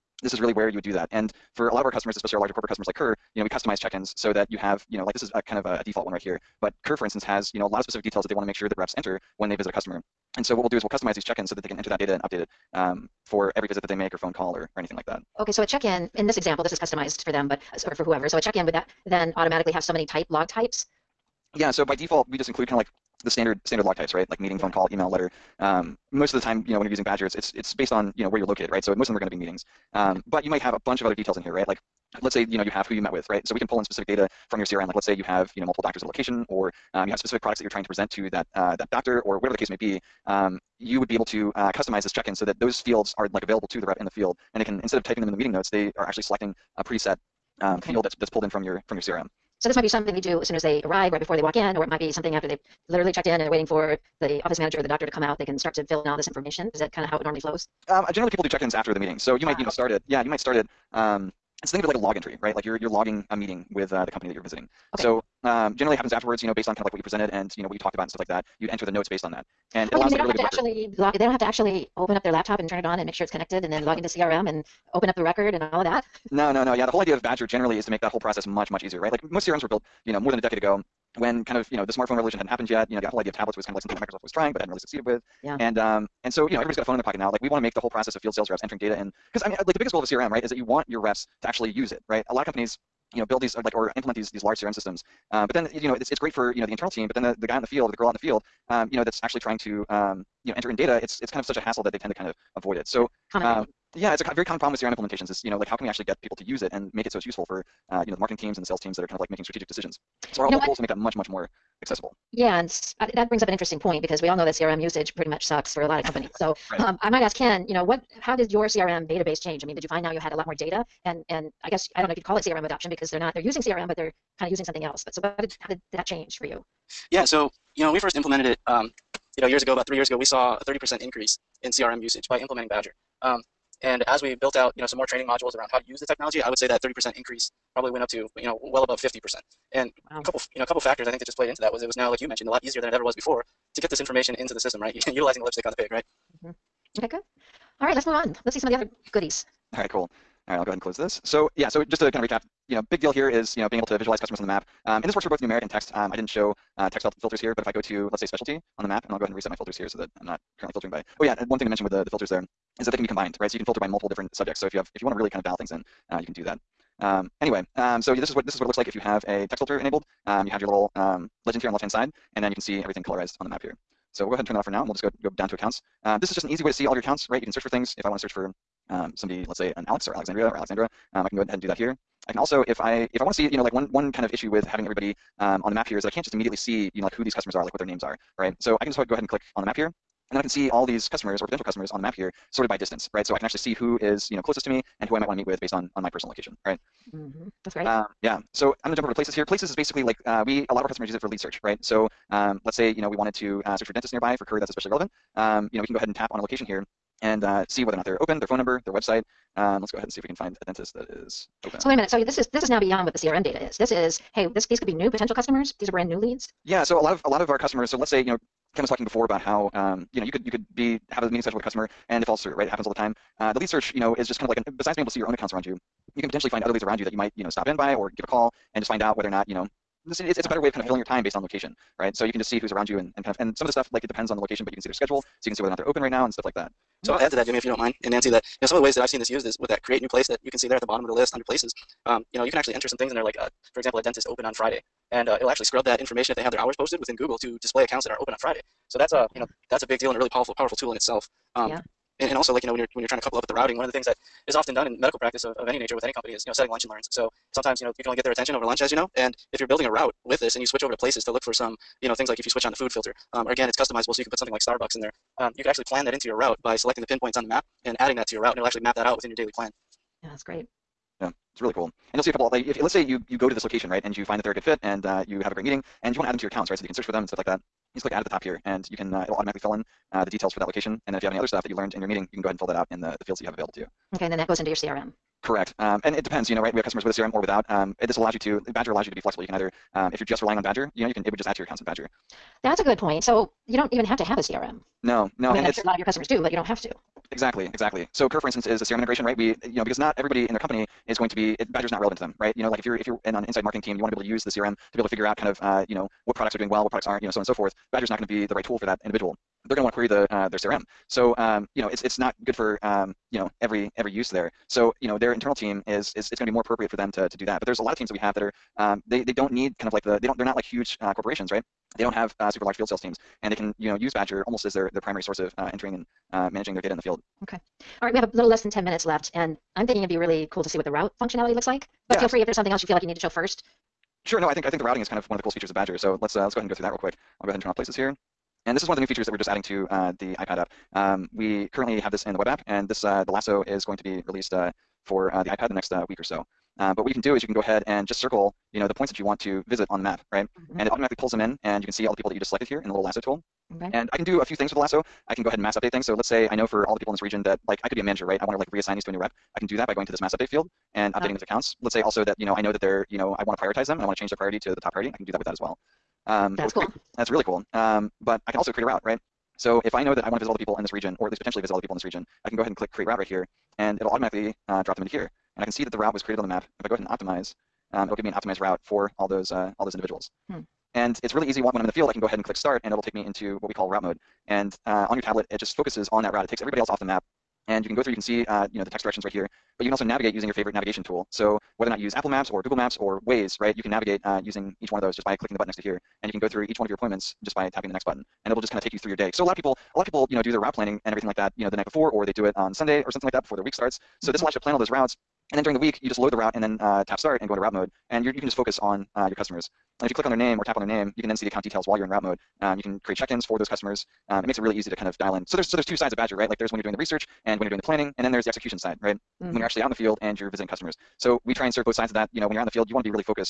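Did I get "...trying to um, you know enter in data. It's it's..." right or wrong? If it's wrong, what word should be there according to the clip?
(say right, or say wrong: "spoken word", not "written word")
right.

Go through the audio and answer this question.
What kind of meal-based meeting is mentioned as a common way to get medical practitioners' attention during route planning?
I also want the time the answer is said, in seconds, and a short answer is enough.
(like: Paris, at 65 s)
lunch and learns, at 256 s.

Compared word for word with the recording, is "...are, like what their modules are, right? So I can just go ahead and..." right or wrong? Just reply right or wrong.
wrong.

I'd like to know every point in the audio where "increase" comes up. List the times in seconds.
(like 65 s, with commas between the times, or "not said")
131 s, 137 s.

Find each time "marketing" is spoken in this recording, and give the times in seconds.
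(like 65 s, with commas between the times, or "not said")
108 s, 303 s.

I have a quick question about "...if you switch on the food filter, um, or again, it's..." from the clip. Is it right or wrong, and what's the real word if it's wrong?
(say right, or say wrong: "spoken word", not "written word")
right.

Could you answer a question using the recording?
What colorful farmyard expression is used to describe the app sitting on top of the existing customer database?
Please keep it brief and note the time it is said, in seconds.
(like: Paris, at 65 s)
lipstick on the pig, at 145 s.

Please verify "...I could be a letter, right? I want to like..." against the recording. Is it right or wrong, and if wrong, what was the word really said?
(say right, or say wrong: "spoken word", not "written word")
wrong: "manager", not "letter".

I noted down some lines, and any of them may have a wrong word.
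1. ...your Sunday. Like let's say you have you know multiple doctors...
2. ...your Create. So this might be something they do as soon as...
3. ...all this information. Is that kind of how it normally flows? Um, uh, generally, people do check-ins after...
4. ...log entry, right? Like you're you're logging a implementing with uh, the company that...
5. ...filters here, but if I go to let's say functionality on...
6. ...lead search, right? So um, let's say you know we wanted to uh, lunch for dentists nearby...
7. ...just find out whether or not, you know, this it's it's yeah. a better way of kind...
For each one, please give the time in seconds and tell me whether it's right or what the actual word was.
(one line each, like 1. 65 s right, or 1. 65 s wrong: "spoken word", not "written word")
1. 34 s wrong: "CRM", not "Sunday"
2. 48 s wrong: "CRM", not "Create"
3. 56 s right
4. 61 s wrong: "meeting", not "implementing"
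5. 157 s wrong: "specialty", not "functionality"
6. 201 s wrong: "search", not "lunch"
7. 228 s right.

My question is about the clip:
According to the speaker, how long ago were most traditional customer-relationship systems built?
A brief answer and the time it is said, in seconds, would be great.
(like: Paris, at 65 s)
more than a decade ago, at 80 s.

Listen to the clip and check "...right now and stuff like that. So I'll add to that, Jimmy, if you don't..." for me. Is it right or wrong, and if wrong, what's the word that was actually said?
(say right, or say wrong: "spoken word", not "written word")
right.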